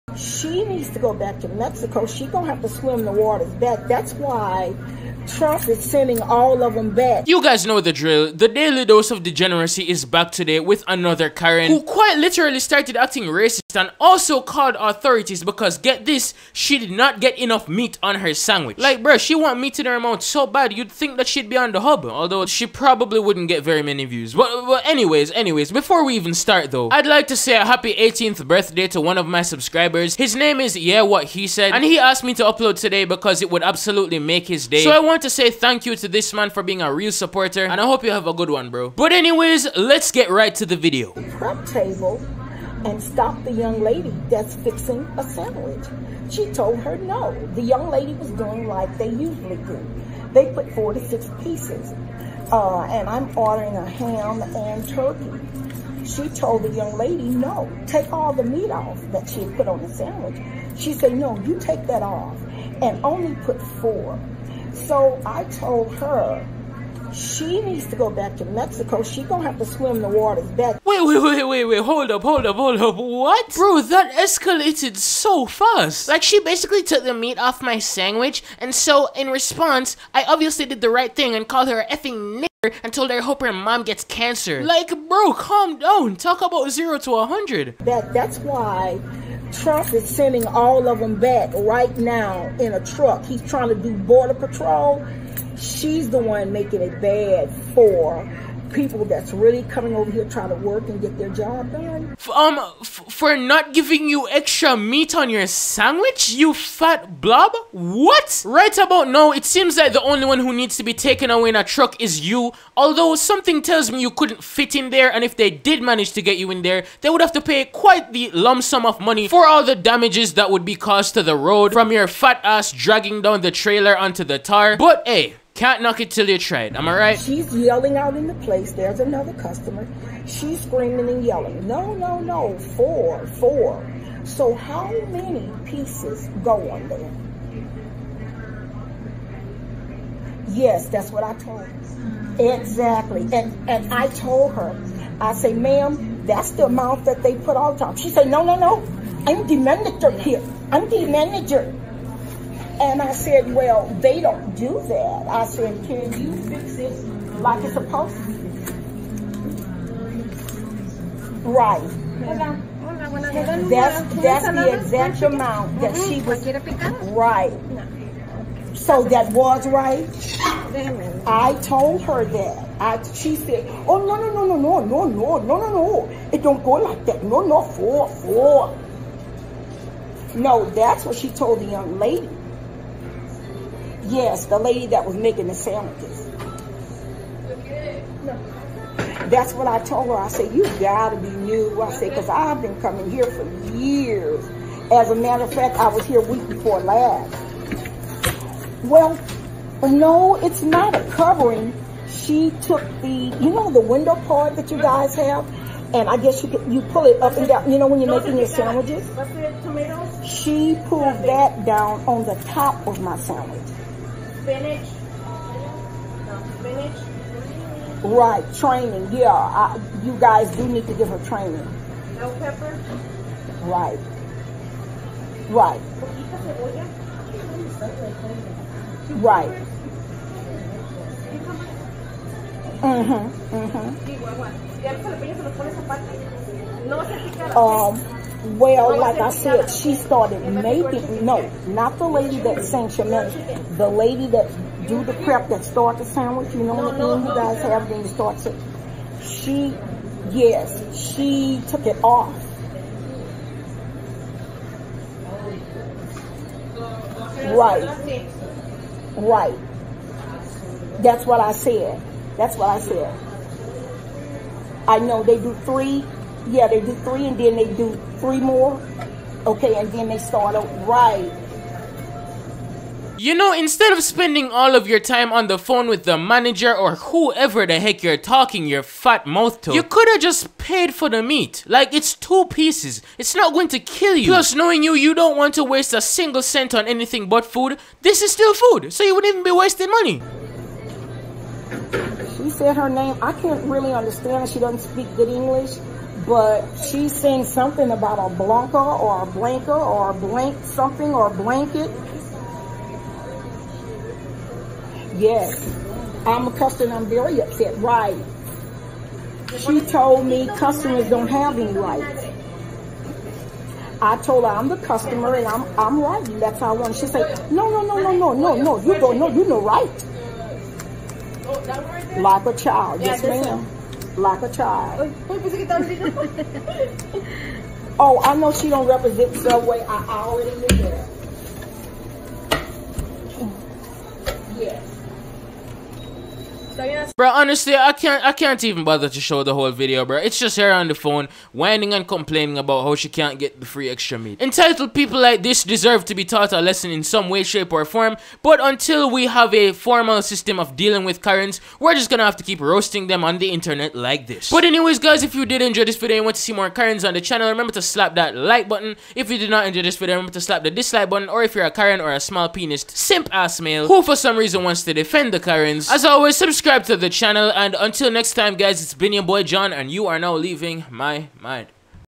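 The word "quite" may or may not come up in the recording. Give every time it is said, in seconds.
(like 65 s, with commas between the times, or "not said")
11 s, 117 s.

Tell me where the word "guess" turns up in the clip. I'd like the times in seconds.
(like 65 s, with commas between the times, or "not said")
206 s.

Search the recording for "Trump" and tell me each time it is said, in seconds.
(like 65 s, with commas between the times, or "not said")
5 s, 89 s.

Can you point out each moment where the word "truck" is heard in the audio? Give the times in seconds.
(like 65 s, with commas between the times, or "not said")
92 s, 111 s.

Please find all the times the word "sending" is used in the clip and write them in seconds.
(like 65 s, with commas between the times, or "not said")
5 s, 90 s.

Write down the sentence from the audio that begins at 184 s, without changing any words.
Yes, the lady that was making the sandwiches.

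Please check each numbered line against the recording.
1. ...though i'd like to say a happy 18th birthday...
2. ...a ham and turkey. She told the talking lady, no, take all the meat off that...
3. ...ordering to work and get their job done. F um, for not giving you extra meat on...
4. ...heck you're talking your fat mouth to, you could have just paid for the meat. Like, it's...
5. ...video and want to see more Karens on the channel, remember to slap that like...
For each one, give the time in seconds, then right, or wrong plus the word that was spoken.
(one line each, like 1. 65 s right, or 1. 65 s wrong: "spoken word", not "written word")
1. 26 s right
2. 53 s wrong: "young", not "talking"
3. 100 s wrong: "trying", not "ordering"
4. 277 s right
5. 355 s right.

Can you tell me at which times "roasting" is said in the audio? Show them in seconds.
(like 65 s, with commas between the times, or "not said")
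352 s.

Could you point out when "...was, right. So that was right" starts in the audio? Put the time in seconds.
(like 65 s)
166 s.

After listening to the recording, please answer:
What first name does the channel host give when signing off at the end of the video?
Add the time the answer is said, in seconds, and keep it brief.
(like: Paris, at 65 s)
John, at 369 s.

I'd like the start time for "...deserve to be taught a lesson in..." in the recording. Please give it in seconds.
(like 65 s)
345 s.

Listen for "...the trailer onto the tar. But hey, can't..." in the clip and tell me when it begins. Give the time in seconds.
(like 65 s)
123 s.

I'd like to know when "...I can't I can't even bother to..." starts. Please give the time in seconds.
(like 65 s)
337 s.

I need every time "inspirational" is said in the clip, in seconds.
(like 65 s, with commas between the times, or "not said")
not said.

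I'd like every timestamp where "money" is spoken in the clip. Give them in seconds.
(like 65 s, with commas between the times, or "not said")
118 s, 289 s.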